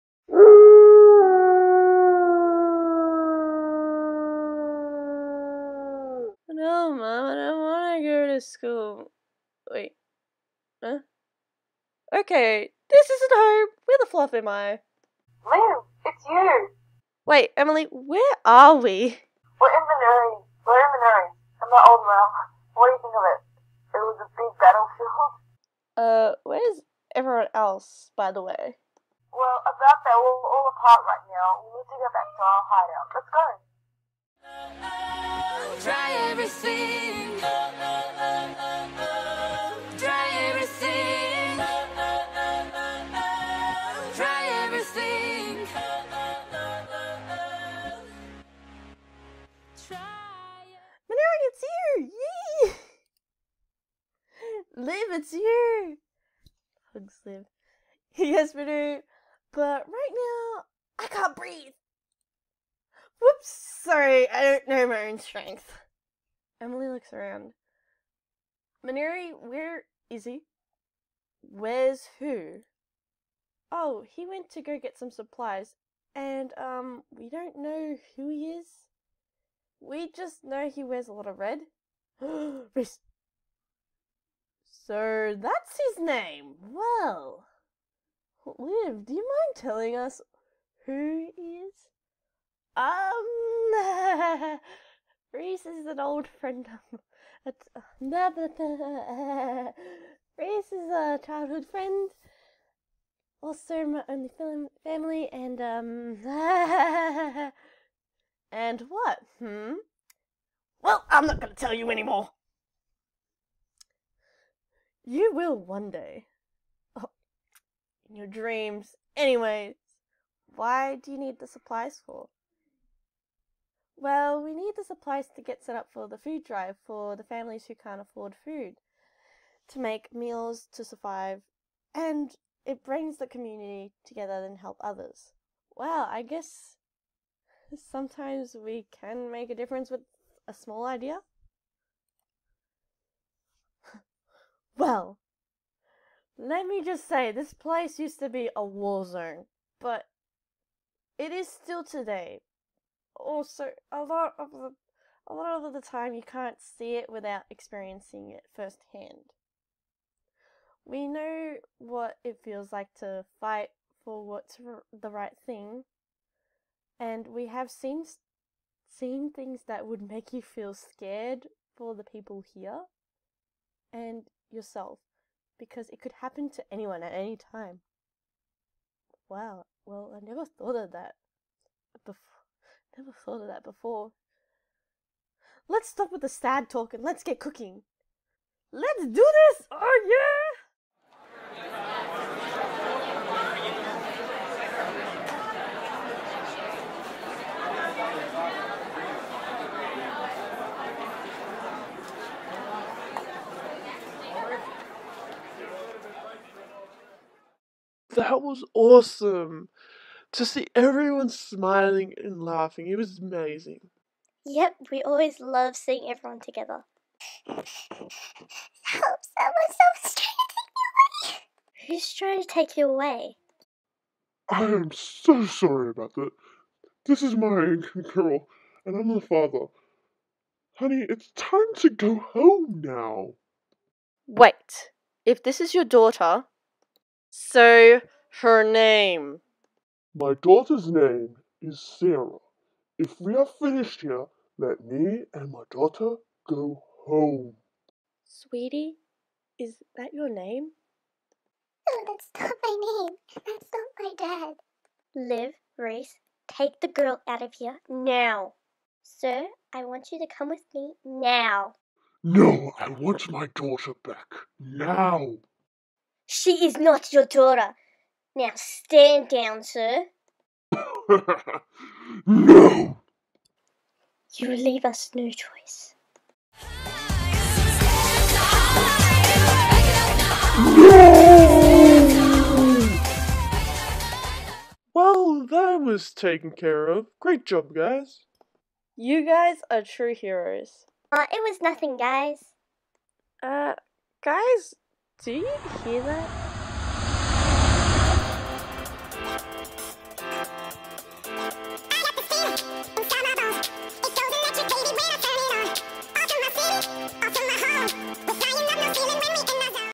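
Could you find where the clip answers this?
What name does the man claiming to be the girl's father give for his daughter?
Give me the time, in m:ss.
4:01.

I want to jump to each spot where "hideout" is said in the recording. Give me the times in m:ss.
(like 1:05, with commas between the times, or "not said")
0:32.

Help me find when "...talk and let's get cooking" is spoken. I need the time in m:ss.
3:06.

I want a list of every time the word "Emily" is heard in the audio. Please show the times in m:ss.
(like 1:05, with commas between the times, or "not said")
0:17, 1:06.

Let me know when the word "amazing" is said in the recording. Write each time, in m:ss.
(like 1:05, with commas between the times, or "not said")
3:33.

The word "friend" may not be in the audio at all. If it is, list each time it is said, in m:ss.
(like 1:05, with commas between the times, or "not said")
1:36, 1:41.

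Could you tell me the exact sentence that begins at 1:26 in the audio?
Well, Liv, do you mind telling us who he is?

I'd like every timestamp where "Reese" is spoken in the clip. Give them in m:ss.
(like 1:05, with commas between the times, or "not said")
1:22, 1:35, 1:40, 4:15.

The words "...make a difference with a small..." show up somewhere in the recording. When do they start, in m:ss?
2:19.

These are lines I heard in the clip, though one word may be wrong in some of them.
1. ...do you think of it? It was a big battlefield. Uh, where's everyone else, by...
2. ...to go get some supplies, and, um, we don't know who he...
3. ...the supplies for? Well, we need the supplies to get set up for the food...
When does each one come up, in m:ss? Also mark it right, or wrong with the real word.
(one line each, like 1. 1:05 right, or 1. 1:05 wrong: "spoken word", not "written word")
1. 0:22 right
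2. 1:14 right
3. 2:01 right.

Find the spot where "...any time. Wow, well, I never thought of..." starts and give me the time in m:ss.
2:57.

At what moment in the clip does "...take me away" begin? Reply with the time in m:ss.
3:41.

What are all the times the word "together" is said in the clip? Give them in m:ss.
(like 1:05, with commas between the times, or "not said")
2:14, 3:36.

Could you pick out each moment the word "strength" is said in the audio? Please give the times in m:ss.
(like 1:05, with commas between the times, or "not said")
1:05.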